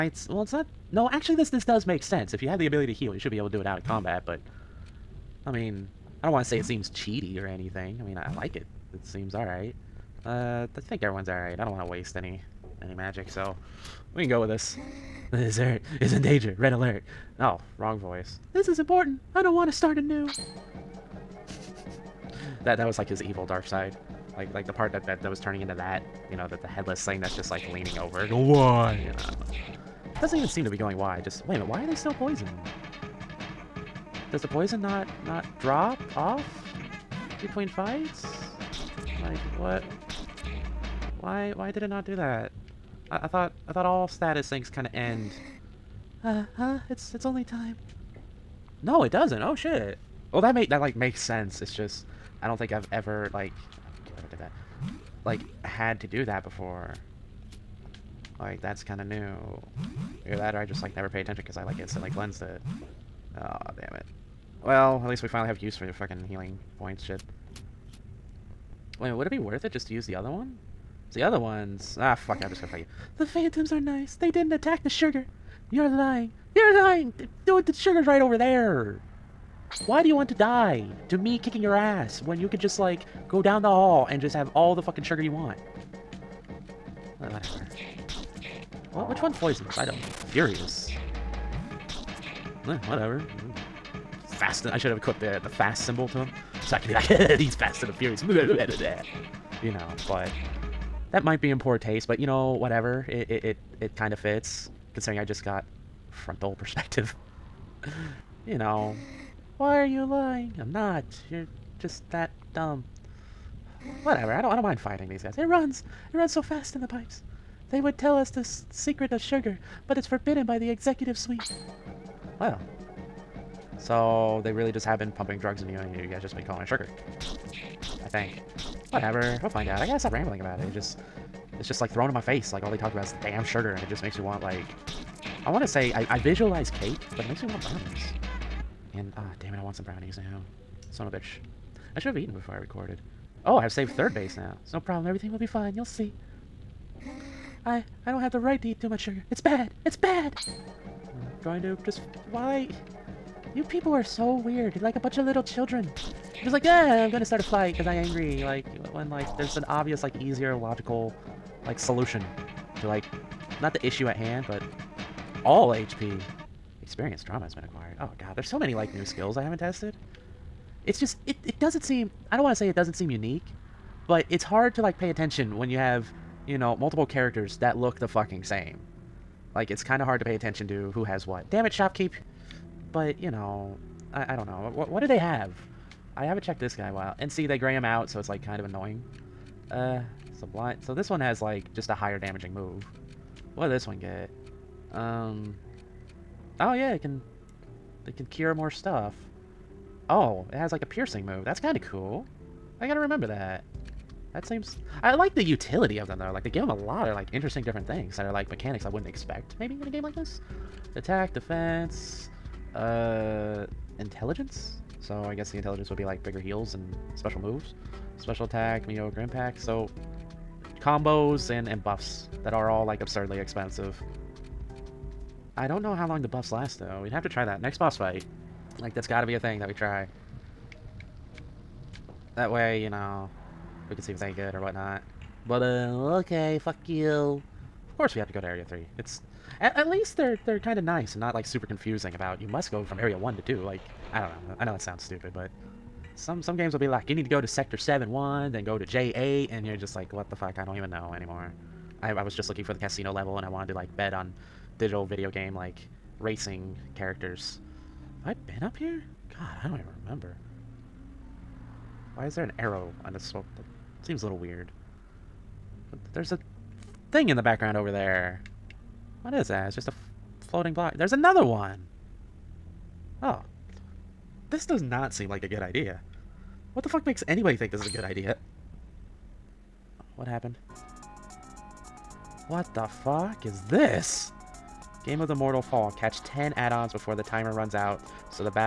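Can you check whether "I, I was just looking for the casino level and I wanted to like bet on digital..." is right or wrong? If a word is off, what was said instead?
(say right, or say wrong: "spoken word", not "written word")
right.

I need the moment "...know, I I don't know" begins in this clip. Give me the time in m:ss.
3:03.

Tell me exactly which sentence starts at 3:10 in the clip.
So this one has like just a higher damaging move.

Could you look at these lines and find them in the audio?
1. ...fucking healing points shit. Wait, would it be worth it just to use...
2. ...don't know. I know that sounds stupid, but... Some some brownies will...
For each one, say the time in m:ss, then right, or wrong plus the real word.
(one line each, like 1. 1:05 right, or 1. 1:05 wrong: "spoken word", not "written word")
1. 1:05 right
2. 4:04 wrong: "games", not "brownies".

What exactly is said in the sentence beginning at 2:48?
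Oh god, there's so many, like, new skills I haven't tested.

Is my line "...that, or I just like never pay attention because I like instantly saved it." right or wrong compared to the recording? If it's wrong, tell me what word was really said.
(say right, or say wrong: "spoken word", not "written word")
wrong: "cleansed", not "saved".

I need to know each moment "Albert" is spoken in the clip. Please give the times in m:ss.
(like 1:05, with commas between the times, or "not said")
not said.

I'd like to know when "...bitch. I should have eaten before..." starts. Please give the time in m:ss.
2:21.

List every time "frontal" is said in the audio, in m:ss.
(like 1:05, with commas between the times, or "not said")
1:46.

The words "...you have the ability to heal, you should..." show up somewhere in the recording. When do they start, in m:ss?
0:02.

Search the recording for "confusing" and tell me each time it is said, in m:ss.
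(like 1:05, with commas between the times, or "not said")
4:01.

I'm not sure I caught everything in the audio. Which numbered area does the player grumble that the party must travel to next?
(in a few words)
Area 3.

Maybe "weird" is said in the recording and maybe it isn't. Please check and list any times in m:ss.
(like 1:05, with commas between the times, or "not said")
2:34, 4:24.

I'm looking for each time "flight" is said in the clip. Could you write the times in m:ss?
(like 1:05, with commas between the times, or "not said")
not said.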